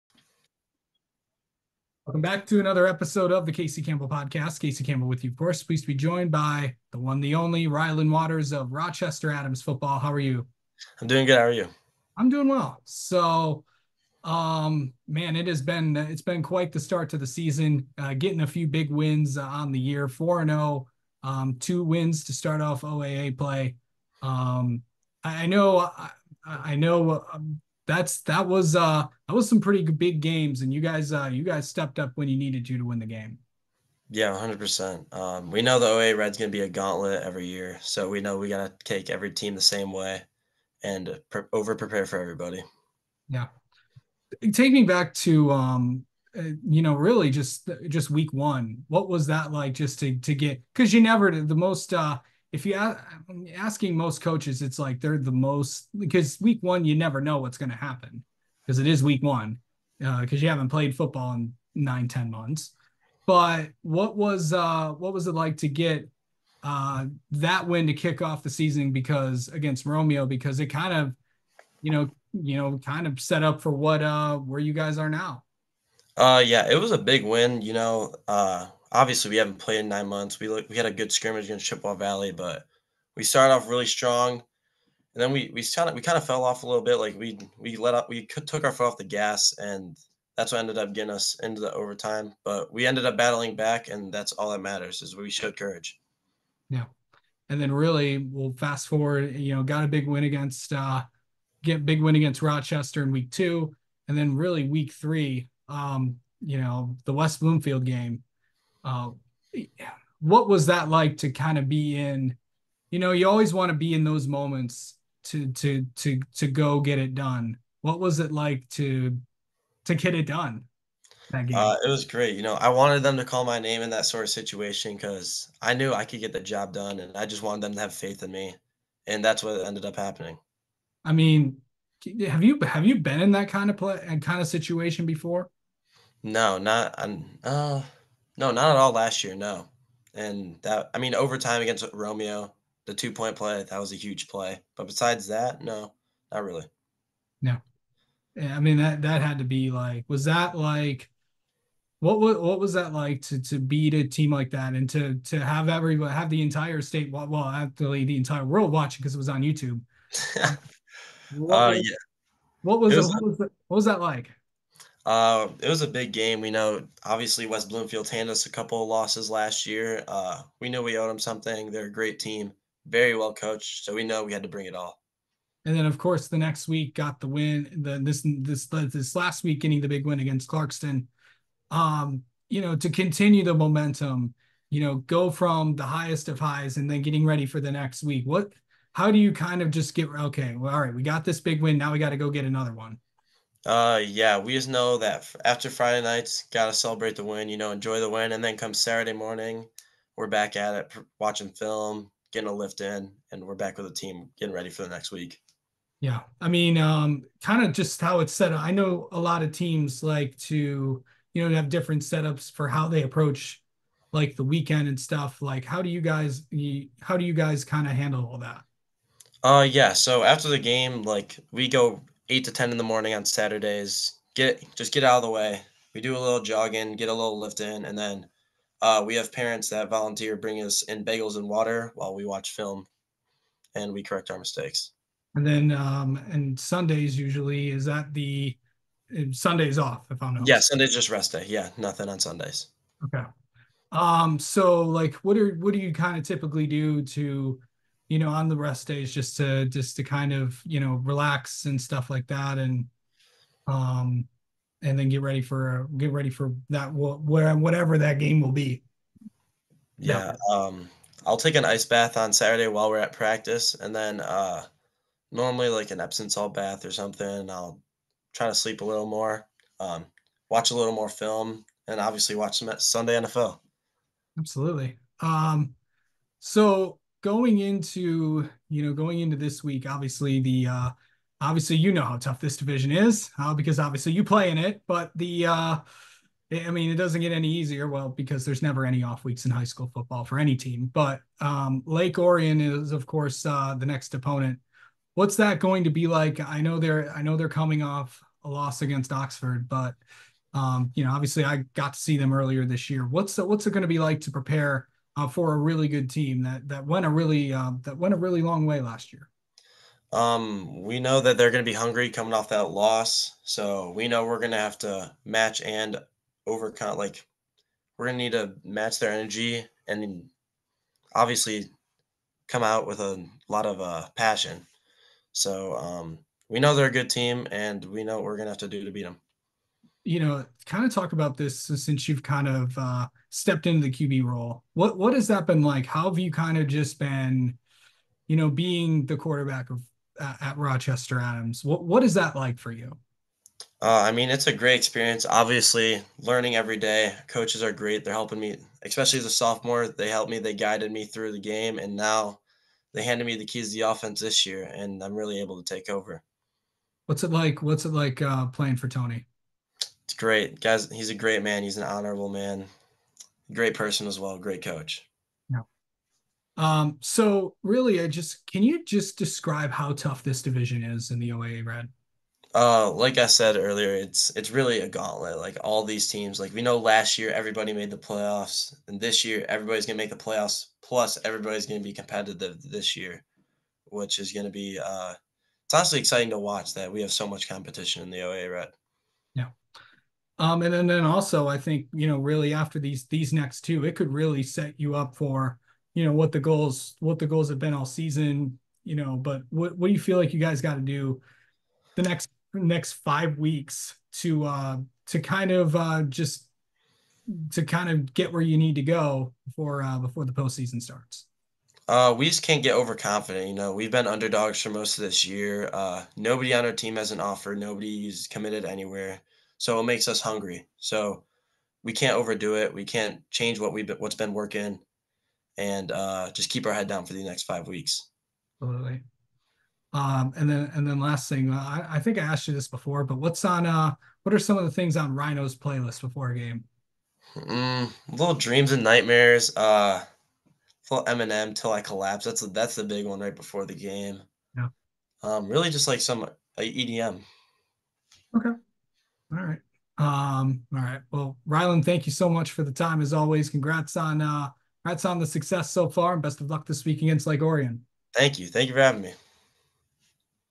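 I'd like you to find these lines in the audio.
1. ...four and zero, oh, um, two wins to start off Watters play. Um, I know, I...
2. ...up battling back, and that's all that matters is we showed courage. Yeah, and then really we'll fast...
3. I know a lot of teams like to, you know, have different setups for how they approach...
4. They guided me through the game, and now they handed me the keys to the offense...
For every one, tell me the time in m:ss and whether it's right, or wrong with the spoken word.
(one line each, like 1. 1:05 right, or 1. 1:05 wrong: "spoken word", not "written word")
1. 0:20 wrong: "OAA", not "Watters"
2. 1:33 right
3. 3:28 right
4. 5:50 right.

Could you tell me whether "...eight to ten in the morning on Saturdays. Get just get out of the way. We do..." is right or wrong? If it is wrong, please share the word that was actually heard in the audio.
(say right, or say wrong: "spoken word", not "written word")
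right.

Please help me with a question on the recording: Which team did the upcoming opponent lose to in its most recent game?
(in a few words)
Oxford.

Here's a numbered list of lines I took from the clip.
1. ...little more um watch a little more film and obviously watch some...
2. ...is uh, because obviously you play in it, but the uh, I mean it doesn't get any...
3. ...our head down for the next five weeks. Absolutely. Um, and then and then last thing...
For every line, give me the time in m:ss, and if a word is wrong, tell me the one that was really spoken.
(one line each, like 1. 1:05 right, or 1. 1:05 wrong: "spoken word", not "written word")
1. 4:28 right
2. 4:42 right
3. 7:06 right.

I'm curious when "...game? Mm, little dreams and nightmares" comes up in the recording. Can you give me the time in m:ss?
7:16.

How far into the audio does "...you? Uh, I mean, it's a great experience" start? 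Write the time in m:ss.
5:42.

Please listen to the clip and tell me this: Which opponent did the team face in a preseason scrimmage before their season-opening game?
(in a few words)
Chippewa Valley.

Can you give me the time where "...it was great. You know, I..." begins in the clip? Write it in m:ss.
2:01.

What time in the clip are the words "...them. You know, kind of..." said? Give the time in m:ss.
5:29.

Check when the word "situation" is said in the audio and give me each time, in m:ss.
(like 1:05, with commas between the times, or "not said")
2:04, 2:14.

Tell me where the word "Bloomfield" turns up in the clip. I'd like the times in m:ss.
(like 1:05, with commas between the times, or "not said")
1:47, 2:47.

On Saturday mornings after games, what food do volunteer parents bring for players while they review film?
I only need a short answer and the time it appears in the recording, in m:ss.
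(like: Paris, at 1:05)
Bagels, at 3:51.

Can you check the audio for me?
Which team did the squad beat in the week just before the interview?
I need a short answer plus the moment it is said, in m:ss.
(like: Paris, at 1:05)
Clarkston, at 3:00.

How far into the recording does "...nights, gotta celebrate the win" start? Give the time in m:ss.
3:16.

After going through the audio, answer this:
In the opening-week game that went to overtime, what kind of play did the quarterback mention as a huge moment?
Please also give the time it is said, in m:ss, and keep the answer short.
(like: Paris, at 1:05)
Two point play, at 2:22.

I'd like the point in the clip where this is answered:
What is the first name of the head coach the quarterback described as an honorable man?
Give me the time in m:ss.
5:58.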